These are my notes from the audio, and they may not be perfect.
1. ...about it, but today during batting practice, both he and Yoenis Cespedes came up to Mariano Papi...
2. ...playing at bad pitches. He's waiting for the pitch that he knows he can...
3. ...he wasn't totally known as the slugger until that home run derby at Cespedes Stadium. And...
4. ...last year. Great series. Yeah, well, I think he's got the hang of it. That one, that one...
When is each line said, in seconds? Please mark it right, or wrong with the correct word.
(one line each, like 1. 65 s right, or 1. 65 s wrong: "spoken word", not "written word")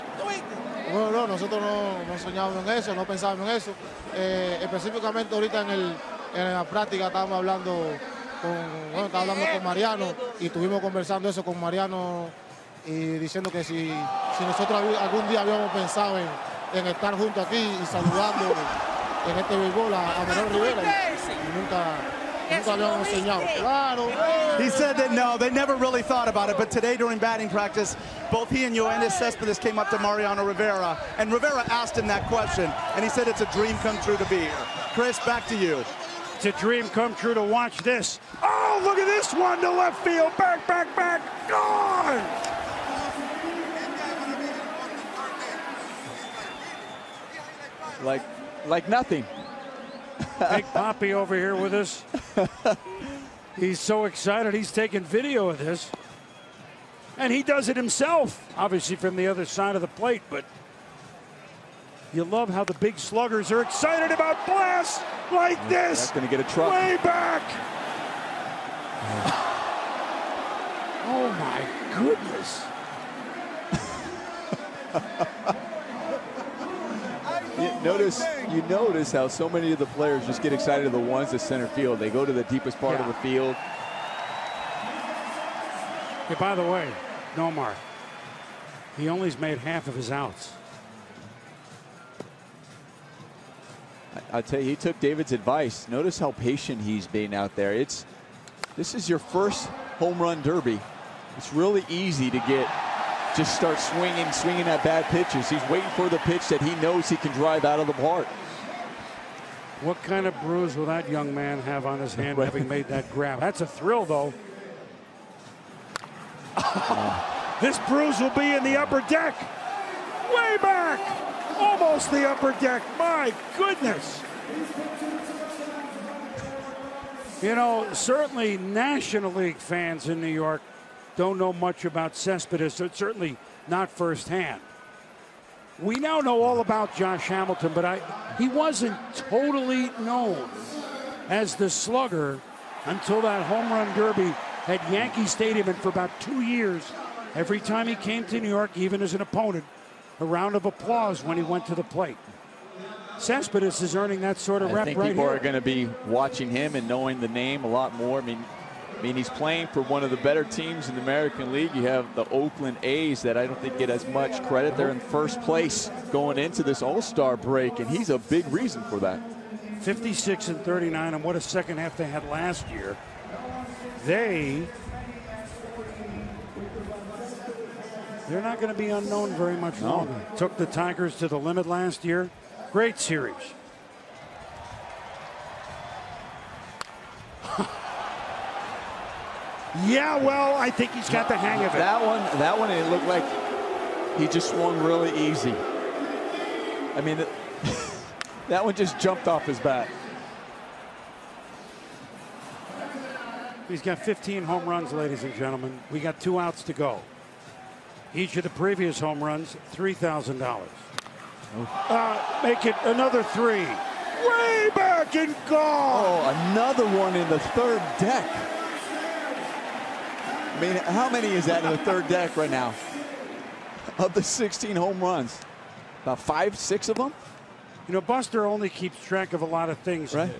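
1. 26 s wrong: "Rivera", not "Papi"
2. 104 s wrong: "swinging", not "playing"
3. 138 s wrong: "Yankee", not "Cespedes"
4. 181 s right.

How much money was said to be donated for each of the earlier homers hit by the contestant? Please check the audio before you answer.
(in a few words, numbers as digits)
$3,000.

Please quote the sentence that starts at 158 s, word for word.
I mean, I mean, he's playing for one of the better teams in the American League.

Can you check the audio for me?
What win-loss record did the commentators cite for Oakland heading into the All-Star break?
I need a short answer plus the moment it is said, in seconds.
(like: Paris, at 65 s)
56 and 39, at 169 s.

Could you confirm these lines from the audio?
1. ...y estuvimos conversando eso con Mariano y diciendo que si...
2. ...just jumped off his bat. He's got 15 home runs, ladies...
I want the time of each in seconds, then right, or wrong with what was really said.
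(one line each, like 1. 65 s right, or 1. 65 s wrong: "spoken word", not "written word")
1. 10 s right
2. 198 s right.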